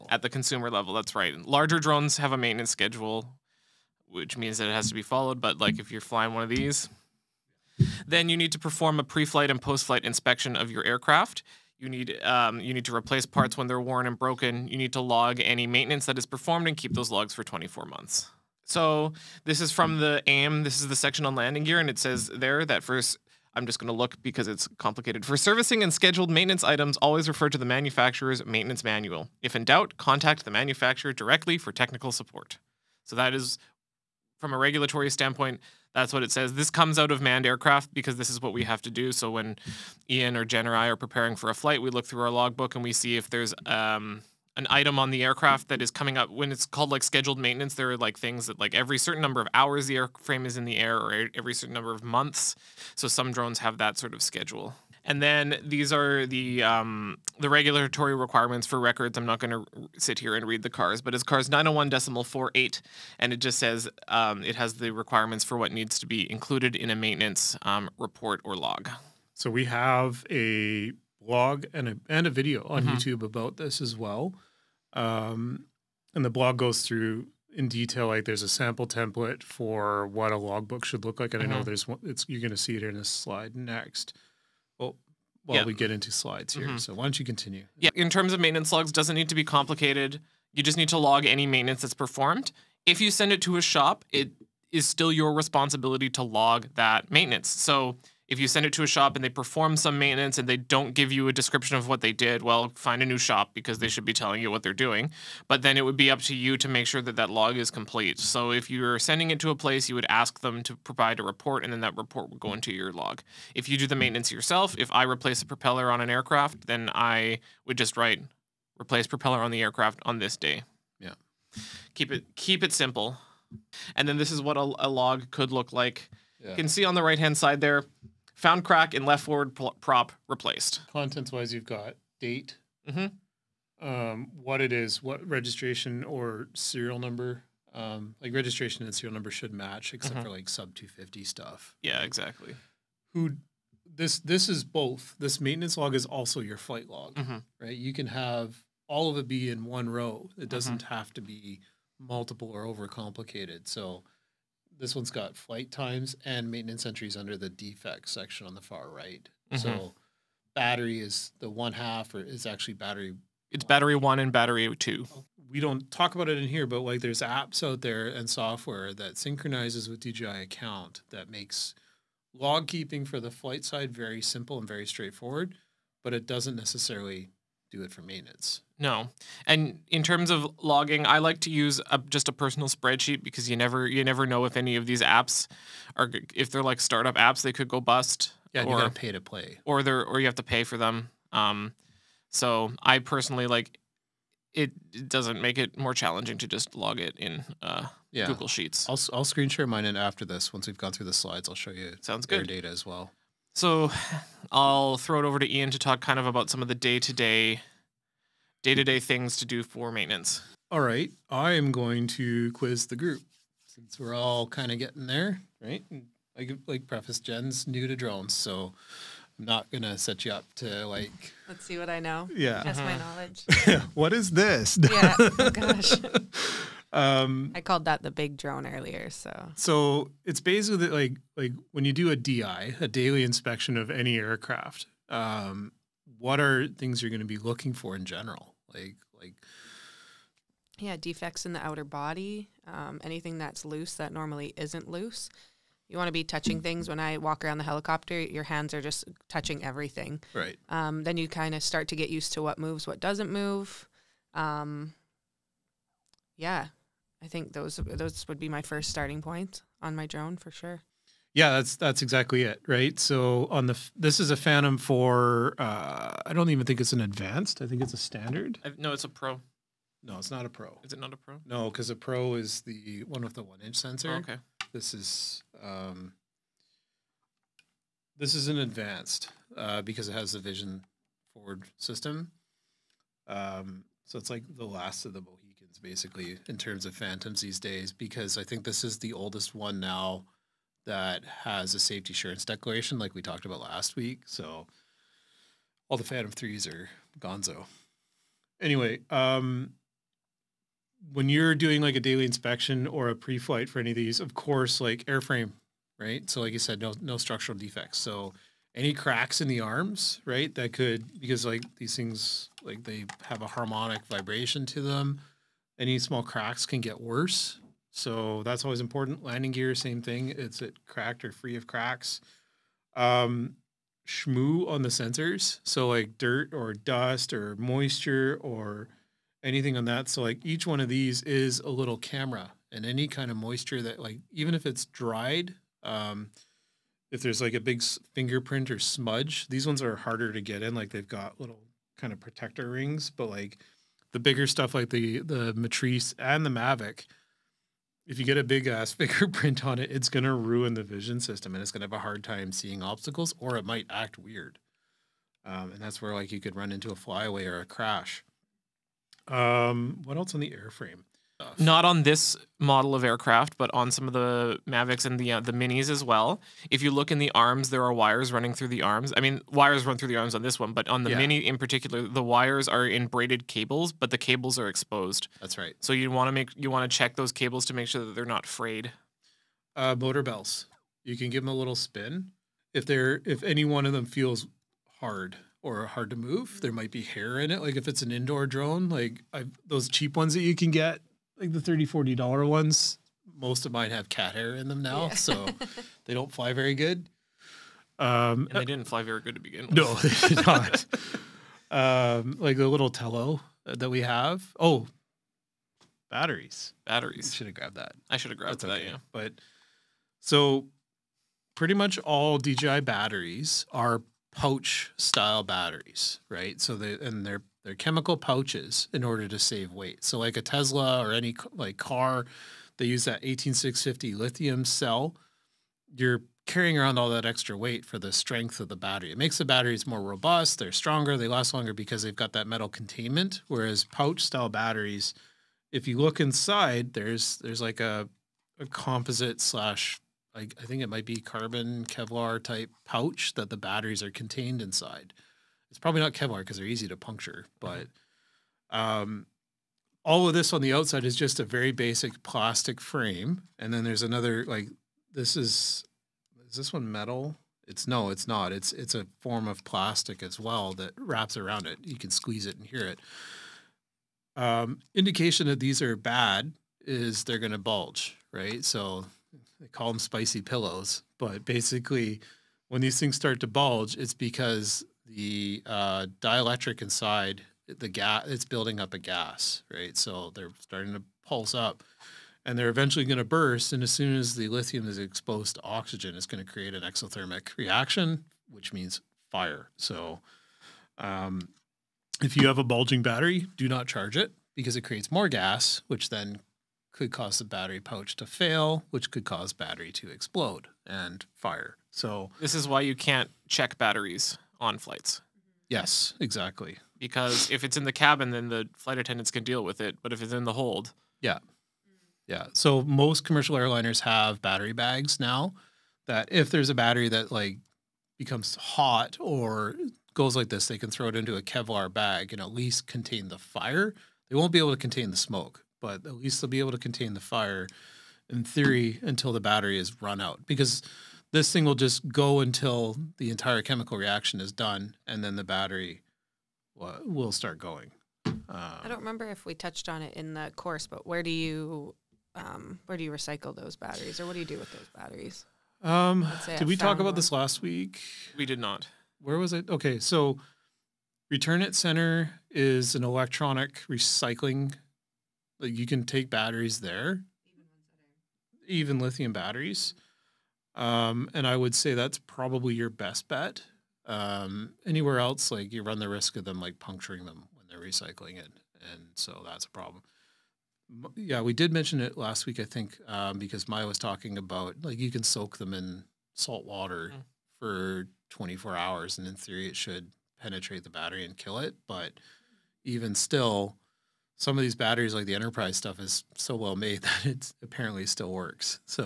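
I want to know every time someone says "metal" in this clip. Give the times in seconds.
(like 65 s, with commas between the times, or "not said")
432 s, 456 s.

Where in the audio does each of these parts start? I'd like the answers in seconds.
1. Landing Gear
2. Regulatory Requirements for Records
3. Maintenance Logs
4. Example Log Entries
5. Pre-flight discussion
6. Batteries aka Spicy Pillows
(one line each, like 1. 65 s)
1. 22 s
2. 54 s
3. 85 s
4. 125 s
5. 210 s
6. 405 s.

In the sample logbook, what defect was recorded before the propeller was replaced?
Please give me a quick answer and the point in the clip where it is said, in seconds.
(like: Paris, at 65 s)
Crack in left forward prop, at 128 s.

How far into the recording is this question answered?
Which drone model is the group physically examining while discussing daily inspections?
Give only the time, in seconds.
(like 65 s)
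264 s.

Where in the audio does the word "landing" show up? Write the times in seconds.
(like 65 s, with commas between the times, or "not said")
21 s, 319 s.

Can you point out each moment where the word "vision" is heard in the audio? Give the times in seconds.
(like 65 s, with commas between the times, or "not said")
280 s, 350 s.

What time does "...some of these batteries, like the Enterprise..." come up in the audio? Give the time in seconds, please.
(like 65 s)
584 s.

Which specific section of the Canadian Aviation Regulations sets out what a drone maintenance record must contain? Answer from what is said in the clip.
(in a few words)
CARS 901.48.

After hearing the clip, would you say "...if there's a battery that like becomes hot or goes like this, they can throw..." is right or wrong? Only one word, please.
right.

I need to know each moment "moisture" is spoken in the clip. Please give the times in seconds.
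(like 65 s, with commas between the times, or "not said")
327 s, 333 s.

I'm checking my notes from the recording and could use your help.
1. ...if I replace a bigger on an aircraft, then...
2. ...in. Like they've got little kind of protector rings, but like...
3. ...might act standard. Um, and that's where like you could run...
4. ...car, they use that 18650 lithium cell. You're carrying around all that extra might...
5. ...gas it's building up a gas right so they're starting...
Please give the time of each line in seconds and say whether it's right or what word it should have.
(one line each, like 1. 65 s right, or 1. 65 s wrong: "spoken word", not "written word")
1. 114 s wrong: "propeller", not "bigger"
2. 340 s right
3. 353 s wrong: "weird", not "standard"
4. 421 s wrong: "weight", not "might"
5. 477 s right.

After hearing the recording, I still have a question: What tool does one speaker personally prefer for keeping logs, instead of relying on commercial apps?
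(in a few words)
Google Sheets.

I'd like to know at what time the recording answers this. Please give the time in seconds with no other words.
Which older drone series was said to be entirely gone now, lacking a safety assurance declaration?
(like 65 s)
296 s.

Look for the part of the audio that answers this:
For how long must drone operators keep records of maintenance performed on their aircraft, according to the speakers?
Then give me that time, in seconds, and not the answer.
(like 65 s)
17 s.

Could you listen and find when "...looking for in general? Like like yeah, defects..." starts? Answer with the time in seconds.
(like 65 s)
237 s.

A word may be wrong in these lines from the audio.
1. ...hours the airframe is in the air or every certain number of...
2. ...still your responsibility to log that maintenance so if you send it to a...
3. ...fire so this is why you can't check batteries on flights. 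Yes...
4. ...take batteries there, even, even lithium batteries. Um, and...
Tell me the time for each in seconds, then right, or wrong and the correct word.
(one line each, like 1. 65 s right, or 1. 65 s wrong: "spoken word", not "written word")
1. 49 s right
2. 94 s right
3. 501 s right
4. 556 s right.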